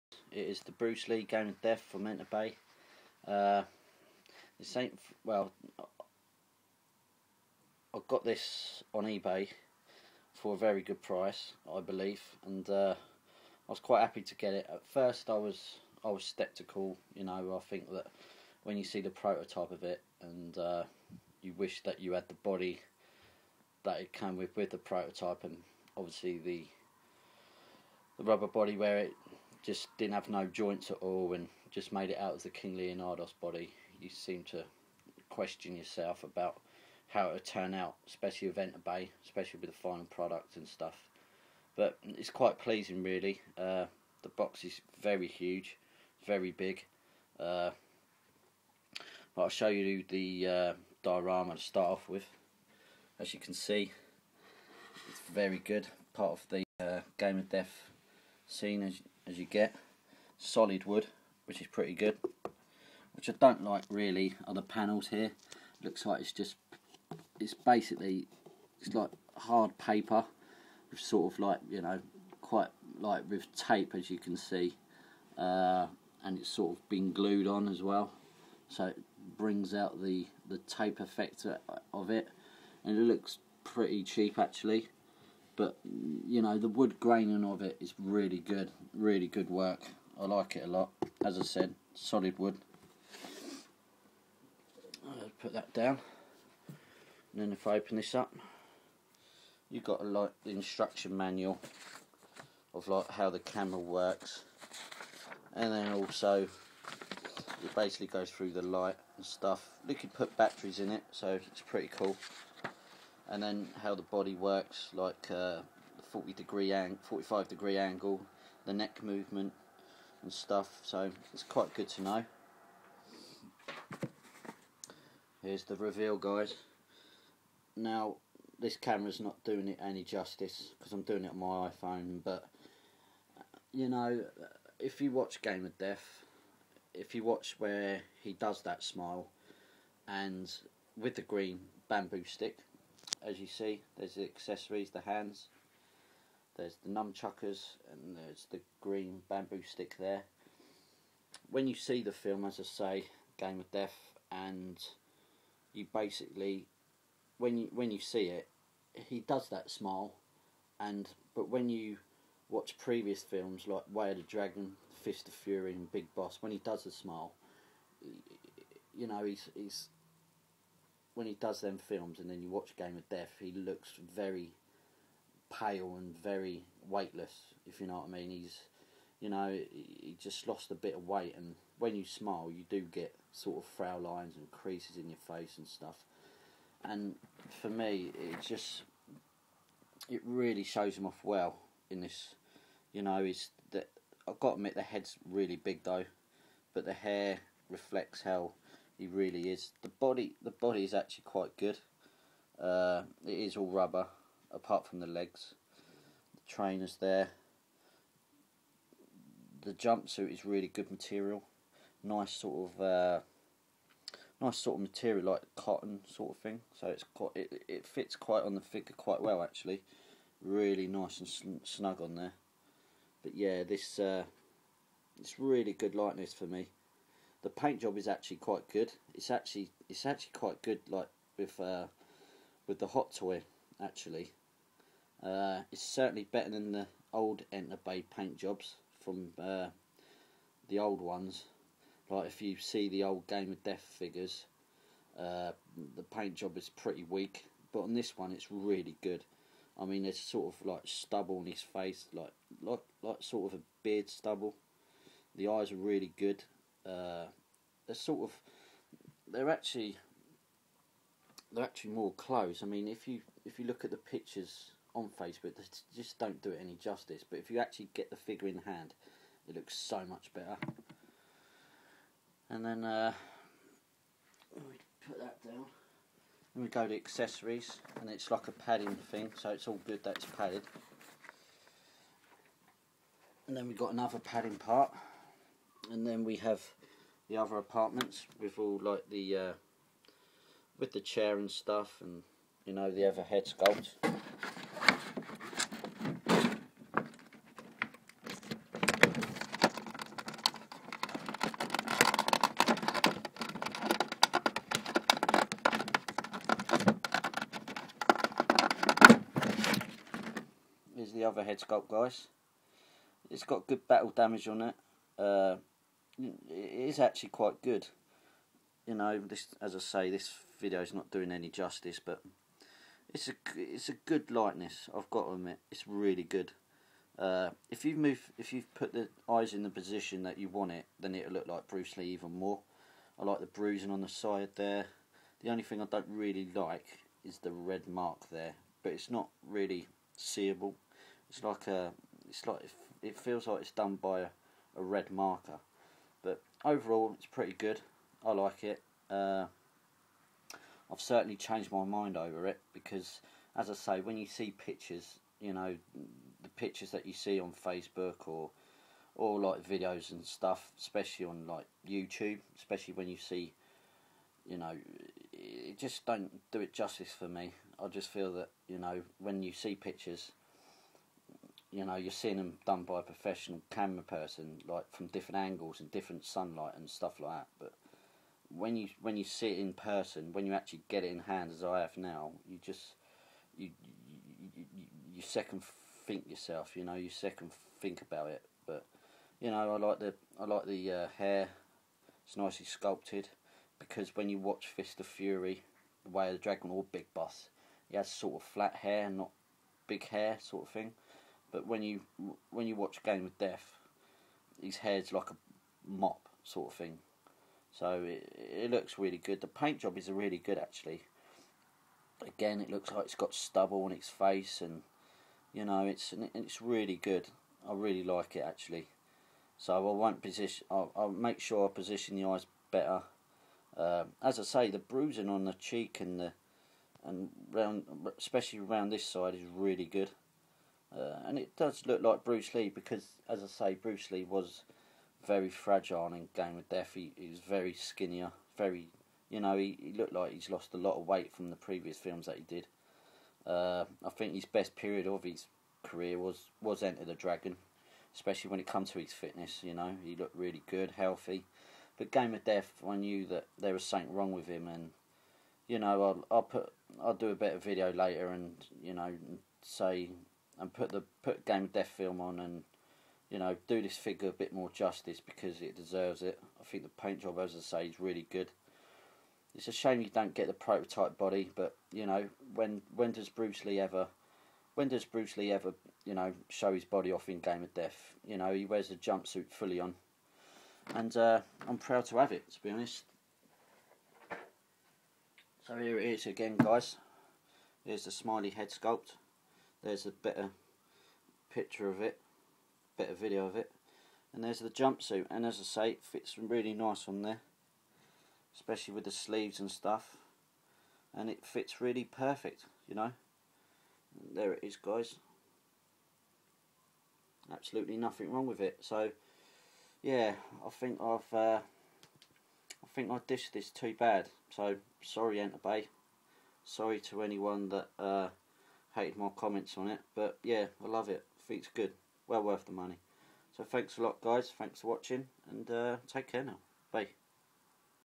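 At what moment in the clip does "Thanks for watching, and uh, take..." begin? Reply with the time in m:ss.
8:44.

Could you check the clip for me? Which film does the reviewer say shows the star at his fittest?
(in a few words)
Enter the Dragon.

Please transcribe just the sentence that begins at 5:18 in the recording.
You know, this as I say, this video is not doing any justice, but it's a it's a good likeness.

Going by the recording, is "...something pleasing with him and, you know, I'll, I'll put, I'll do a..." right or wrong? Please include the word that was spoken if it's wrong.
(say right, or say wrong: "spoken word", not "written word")
wrong: "wrong", not "pleasing".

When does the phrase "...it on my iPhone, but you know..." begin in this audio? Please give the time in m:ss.
2:11.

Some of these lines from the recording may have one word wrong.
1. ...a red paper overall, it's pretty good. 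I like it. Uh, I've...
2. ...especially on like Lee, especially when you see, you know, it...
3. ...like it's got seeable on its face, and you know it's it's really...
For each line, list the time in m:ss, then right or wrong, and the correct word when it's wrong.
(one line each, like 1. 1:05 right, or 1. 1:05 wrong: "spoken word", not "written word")
1. 5:44 wrong: "marker", not "paper"
2. 6:00 wrong: "YouTube", not "Lee"
3. 6:52 wrong: "stubble", not "seeable".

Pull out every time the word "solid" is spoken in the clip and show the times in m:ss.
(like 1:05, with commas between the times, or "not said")
1:00, 1:31.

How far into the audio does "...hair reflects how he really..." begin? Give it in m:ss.
3:16.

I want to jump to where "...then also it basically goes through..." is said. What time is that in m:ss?
1:45.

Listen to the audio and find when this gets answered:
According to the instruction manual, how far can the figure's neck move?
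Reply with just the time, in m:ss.
1:57.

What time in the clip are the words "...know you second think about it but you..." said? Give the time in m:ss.
6:26.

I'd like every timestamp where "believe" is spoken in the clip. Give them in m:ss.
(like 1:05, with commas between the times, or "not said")
0:11.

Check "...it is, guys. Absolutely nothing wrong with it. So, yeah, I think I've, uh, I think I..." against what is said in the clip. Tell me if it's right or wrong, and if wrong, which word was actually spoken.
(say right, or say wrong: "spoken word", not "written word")
right.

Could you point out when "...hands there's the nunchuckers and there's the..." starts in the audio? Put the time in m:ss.
2:25.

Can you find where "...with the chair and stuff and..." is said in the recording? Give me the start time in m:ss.
4:50.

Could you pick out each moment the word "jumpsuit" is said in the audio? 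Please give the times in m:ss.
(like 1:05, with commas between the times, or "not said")
3:29, 7:58, 8:14.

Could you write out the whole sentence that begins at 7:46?
I think the paint job, as I say, is really good.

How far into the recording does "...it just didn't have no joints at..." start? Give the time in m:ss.
0:28.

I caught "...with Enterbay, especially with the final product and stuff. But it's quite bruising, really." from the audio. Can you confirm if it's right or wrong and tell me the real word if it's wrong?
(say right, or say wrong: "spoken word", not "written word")
wrong: "pleasing", not "bruising".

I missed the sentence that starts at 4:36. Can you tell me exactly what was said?
we go to accessories, and it's like a padding thing, so it's all good that it's padded.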